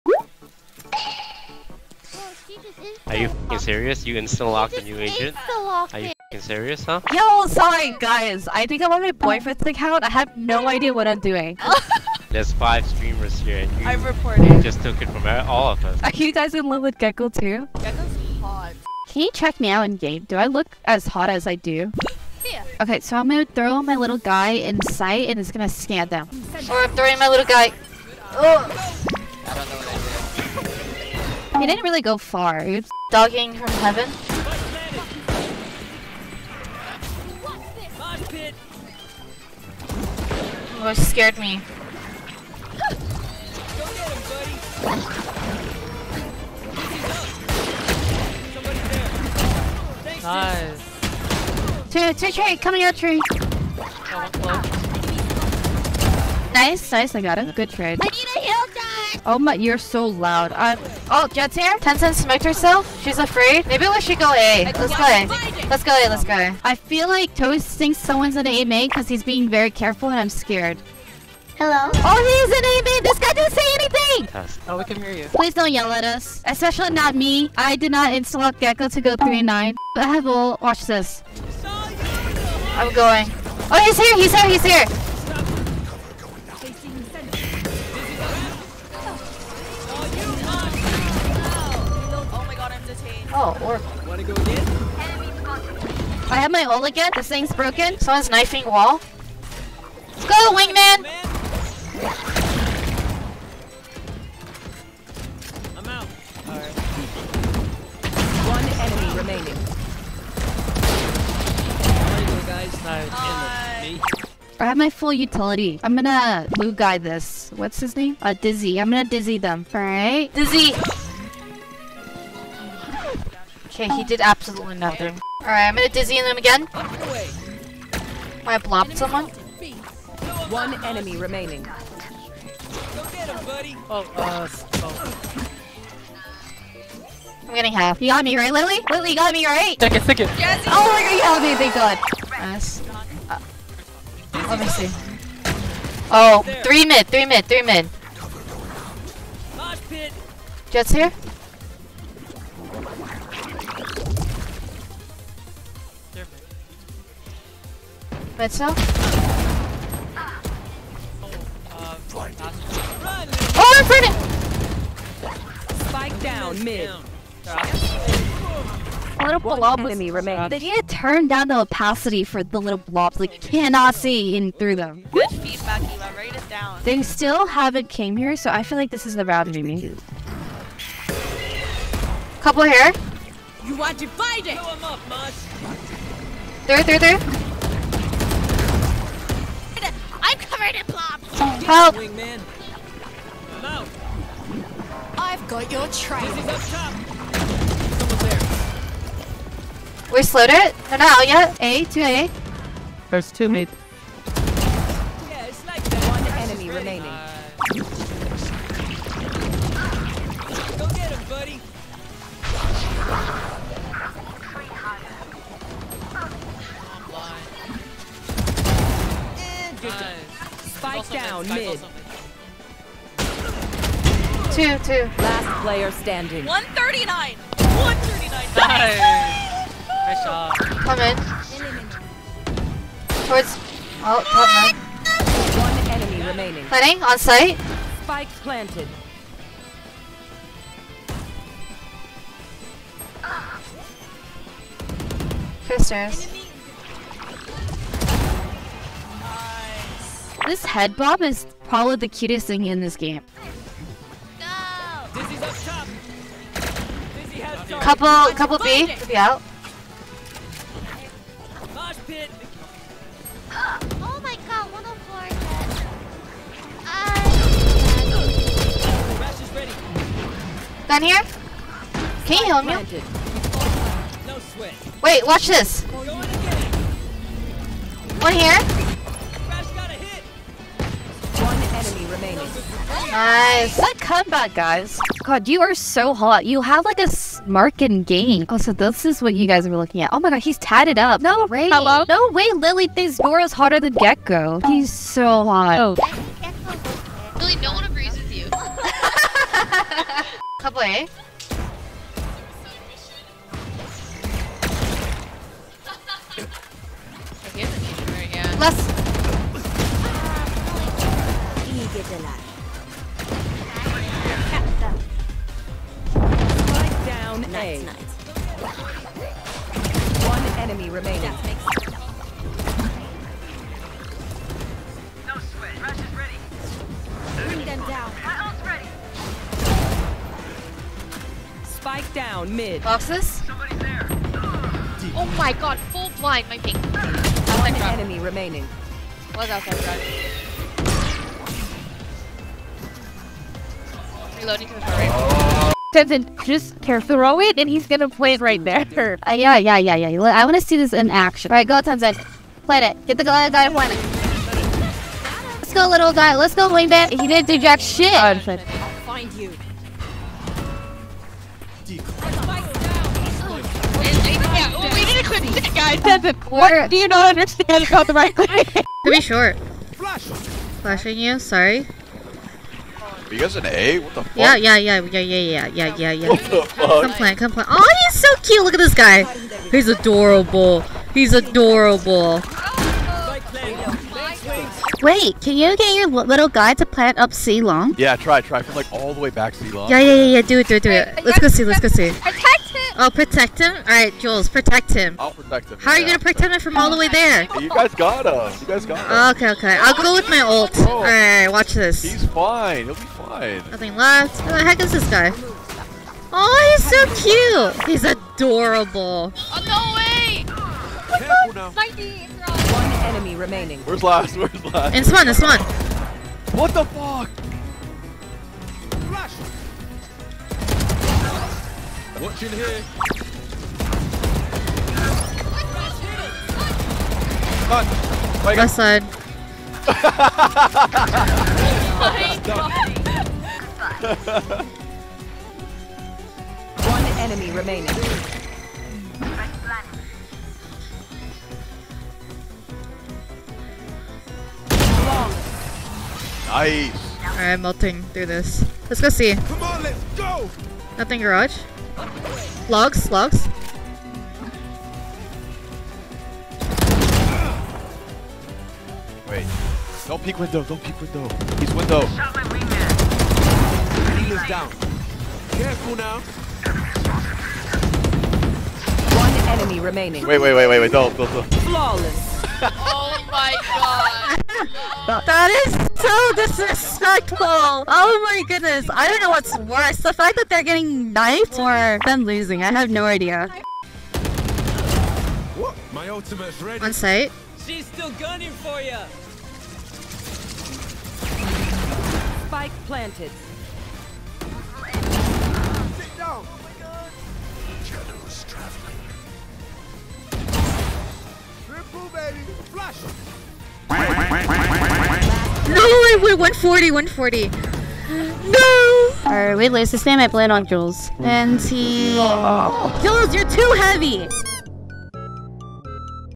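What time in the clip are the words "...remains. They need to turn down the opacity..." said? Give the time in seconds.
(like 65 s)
170 s.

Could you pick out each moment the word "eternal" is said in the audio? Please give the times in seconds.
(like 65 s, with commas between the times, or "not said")
not said.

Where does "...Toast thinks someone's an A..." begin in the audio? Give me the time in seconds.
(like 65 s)
67 s.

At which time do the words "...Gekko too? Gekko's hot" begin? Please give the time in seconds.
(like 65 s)
16 s.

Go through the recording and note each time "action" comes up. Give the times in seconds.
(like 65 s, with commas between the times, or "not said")
351 s.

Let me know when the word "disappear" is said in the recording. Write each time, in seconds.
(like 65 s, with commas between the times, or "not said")
not said.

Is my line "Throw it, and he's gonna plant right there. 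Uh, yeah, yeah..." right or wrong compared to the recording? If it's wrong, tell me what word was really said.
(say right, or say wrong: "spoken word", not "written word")
right.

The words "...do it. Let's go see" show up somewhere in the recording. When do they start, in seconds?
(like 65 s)
390 s.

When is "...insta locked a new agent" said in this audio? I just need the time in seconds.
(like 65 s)
4 s.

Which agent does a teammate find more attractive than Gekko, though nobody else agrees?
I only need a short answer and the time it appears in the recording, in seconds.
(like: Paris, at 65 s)
Dora, at 293 s.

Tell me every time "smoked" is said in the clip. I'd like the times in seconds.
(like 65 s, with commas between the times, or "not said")
62 s.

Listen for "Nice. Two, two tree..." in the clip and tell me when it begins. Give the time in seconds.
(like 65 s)
50 s.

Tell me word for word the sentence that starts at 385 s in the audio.
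Wait, can you get your little guy to plant up C long?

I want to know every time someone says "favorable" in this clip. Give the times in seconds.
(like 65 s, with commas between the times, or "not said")
not said.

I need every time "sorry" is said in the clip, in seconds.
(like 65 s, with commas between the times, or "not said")
7 s, 371 s.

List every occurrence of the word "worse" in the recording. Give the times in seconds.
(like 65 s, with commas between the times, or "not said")
479 s.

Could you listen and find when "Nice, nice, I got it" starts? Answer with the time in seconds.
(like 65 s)
56 s.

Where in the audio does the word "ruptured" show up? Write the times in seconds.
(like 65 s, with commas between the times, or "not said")
not said.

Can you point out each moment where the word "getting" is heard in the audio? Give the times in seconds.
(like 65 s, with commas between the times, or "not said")
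137 s, 480 s.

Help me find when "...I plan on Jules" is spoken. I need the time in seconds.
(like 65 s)
510 s.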